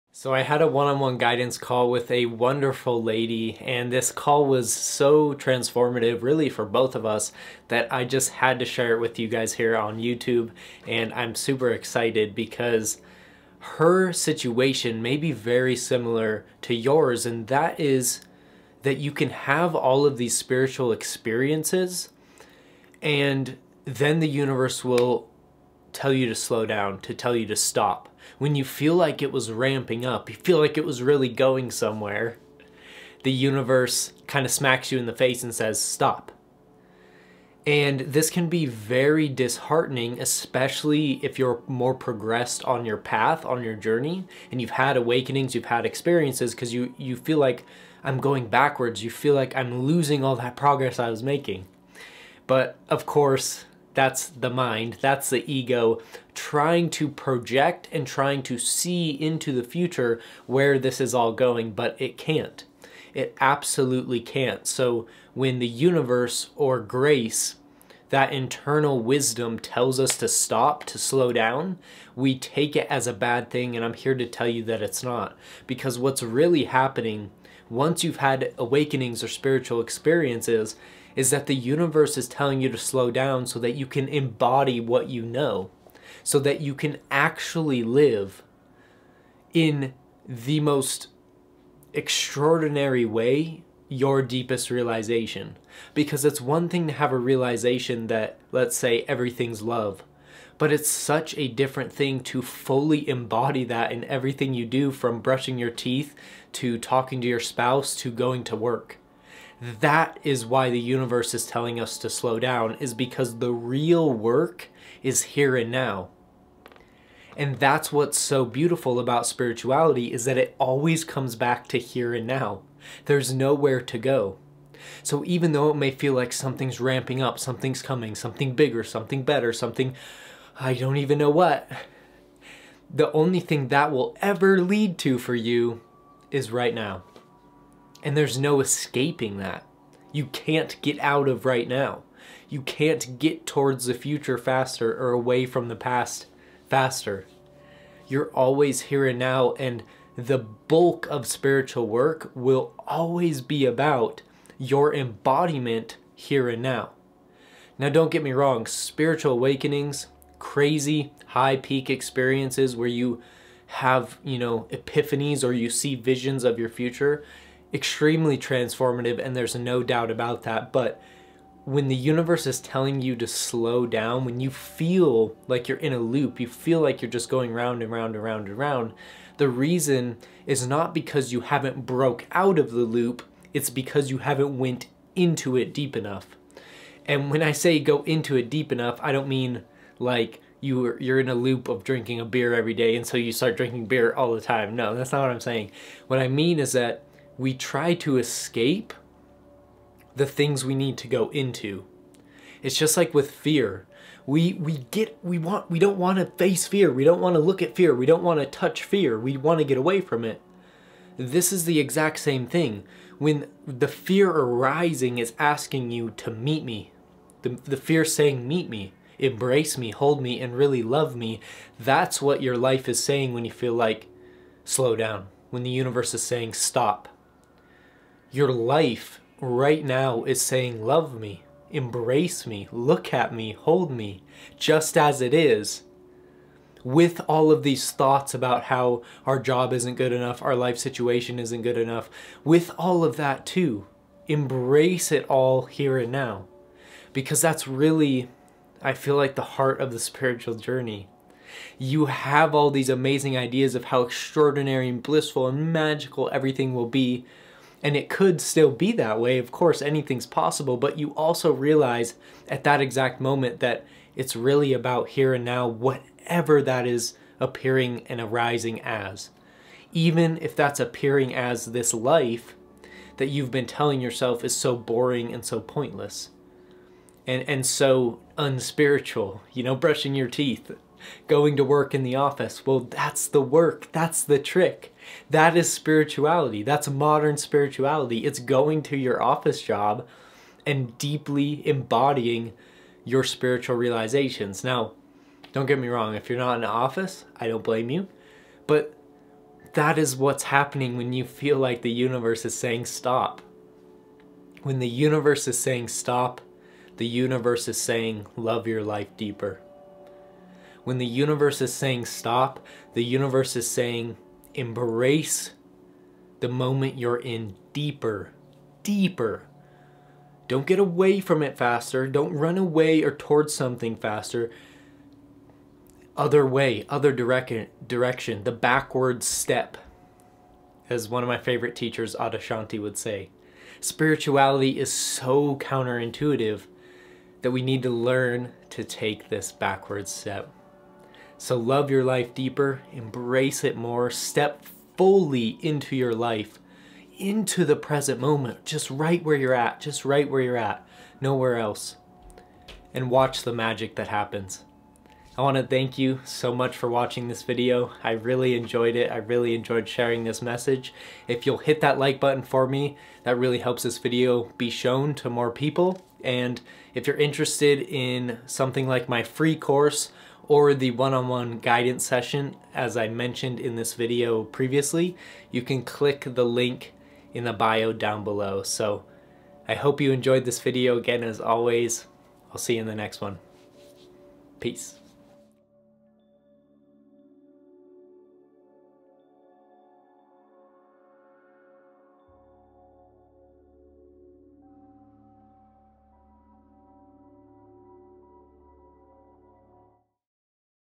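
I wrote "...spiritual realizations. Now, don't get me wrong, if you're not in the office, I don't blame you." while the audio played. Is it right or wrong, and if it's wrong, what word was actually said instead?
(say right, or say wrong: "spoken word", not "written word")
right.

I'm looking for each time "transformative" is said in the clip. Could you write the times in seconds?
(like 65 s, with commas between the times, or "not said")
5 s, 168 s.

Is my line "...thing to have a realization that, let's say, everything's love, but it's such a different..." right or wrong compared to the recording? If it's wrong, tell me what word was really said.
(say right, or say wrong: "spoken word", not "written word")
right.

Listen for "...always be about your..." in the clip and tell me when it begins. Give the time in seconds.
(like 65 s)
152 s.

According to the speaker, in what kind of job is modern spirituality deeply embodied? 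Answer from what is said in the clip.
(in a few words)
office job.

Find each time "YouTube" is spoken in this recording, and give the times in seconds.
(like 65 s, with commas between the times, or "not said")
9 s.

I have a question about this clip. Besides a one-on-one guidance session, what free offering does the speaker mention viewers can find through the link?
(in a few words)
free course.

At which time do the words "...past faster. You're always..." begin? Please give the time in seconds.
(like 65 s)
145 s.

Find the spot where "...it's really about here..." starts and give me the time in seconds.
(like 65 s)
264 s.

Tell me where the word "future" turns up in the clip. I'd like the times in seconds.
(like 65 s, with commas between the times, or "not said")
59 s, 143 s, 166 s.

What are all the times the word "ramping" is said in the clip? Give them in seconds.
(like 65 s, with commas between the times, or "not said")
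29 s, 126 s.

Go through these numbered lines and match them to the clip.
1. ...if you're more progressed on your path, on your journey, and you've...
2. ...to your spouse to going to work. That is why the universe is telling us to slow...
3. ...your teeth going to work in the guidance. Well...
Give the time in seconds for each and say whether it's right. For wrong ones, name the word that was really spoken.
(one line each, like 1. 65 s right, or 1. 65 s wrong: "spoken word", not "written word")
1. 41 s right
2. 107 s right
3. 280 s wrong: "office", not "guidance".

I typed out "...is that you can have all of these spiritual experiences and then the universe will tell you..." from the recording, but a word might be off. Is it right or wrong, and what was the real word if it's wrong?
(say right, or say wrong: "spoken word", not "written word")
right.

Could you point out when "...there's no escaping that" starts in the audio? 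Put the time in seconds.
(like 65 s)
138 s.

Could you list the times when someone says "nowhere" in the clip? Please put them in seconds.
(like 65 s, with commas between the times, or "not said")
123 s, 351 s.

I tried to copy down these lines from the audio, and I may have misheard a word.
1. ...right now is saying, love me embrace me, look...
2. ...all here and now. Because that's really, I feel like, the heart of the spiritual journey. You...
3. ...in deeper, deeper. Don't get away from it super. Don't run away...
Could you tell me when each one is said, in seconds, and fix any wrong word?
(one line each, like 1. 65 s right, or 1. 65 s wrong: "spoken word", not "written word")
1. 229 s right
2. 245 s right
3. 317 s wrong: "faster", not "super".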